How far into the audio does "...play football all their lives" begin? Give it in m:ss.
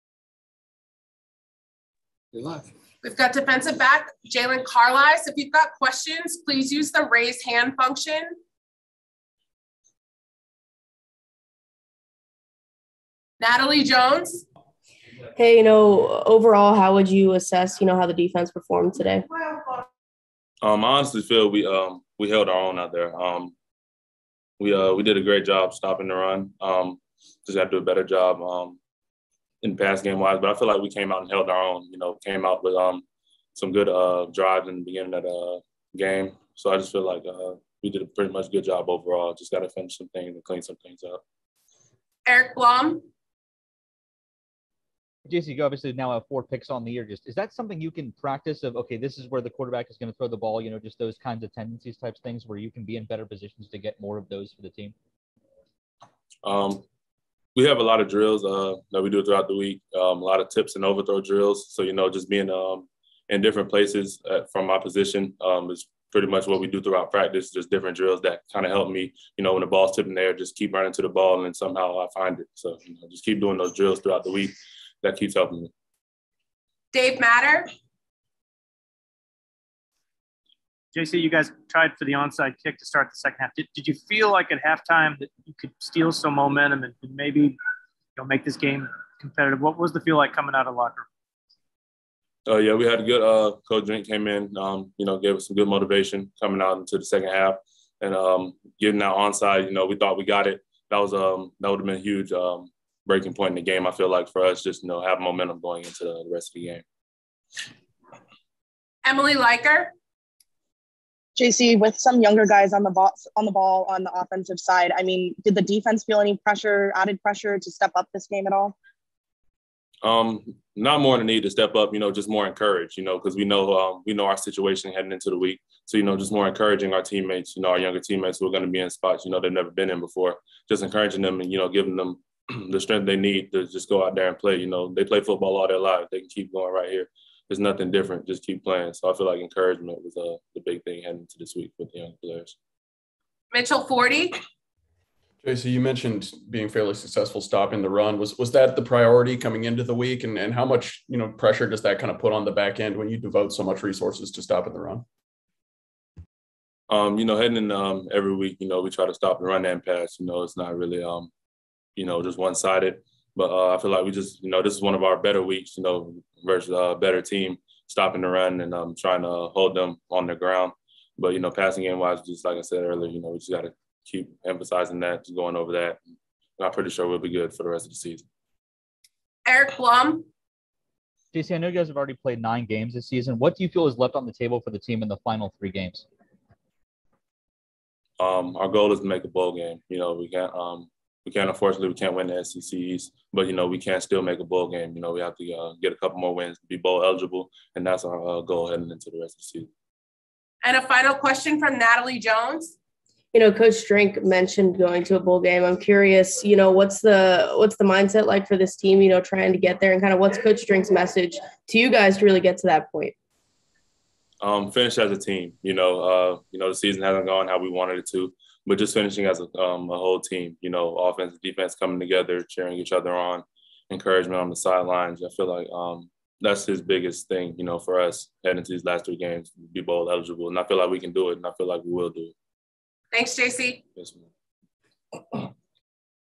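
2:15.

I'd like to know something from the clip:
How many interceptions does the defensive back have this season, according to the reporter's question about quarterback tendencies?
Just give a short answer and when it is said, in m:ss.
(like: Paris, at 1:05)
4, at 0:46.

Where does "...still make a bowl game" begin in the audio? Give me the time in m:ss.
3:14.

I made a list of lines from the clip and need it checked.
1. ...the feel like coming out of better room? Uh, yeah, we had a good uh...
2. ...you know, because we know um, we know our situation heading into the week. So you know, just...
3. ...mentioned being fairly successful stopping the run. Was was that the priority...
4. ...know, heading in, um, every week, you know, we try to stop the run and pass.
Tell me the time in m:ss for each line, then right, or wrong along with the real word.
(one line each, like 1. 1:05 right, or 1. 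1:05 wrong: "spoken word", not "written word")
1. 1:29 wrong: "locker", not "better"
2. 2:02 right
3. 2:25 right
4. 2:37 right.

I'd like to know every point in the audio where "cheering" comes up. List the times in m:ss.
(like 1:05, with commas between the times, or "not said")
3:42.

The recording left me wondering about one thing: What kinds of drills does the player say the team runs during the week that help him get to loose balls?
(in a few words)
Tips and overthrow drills.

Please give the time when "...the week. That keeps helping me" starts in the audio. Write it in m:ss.
1:14.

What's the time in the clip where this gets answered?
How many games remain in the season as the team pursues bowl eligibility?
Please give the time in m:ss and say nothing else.
3:05.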